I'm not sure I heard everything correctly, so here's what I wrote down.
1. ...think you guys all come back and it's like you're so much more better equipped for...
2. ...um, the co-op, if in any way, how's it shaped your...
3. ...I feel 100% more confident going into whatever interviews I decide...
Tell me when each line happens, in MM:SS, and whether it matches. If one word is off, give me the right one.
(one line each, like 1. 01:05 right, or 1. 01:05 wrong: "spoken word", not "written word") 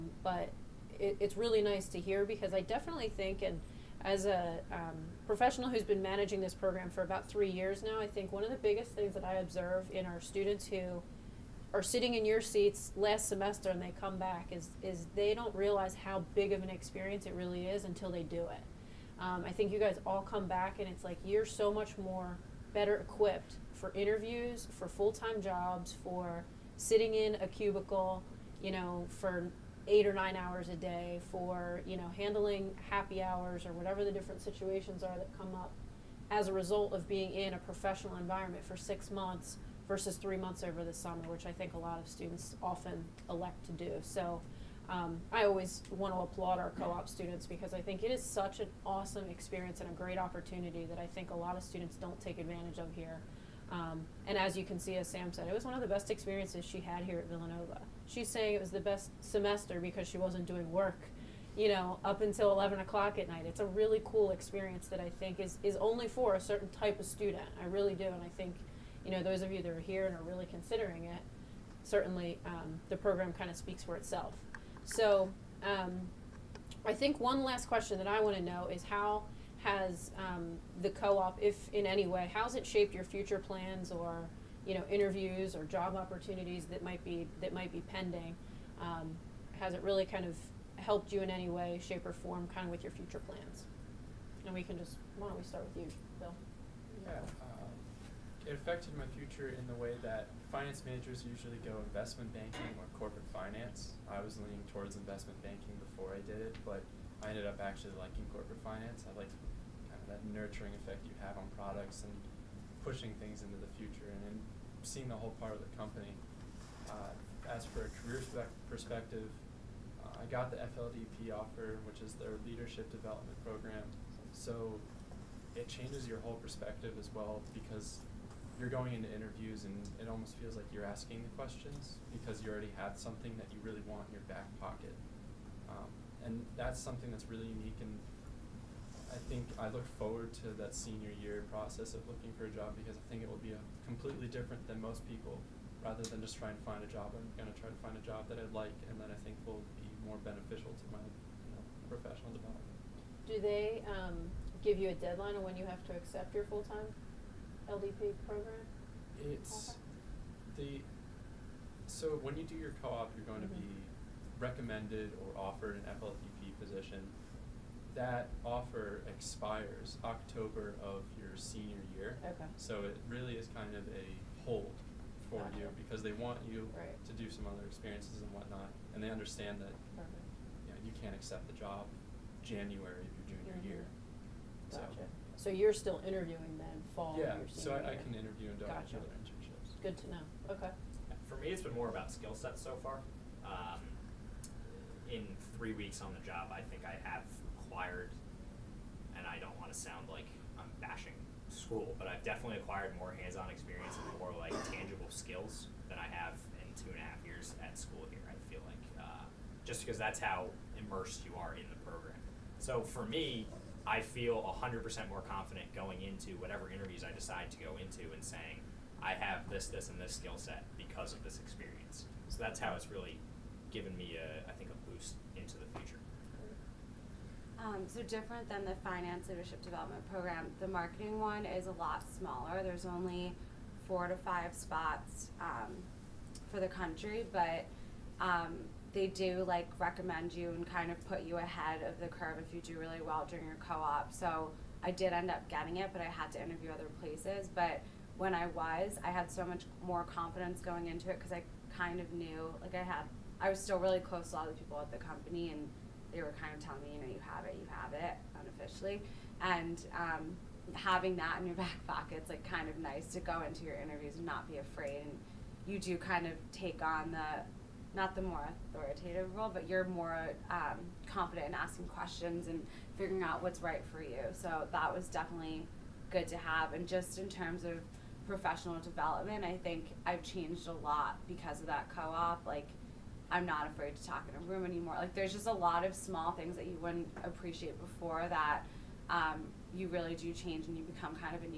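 1. 00:19 right
2. 01:20 right
3. 03:33 right.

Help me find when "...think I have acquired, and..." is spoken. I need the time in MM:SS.
03:16.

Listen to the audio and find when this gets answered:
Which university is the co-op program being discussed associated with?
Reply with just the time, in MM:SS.
00:57.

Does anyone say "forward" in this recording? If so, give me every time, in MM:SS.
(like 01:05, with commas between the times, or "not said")
02:19.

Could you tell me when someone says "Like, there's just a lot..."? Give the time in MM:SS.
04:44.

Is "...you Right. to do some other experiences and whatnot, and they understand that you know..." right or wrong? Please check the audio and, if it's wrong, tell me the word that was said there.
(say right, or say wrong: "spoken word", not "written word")
right.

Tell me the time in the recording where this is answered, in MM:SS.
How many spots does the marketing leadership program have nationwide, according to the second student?
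03:53.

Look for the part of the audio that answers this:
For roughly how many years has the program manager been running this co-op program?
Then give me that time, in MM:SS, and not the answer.
00:07.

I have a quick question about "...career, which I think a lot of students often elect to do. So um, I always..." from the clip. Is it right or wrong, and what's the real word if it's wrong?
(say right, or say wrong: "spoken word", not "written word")
wrong: "summer", not "career".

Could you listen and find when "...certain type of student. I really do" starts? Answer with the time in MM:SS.
01:06.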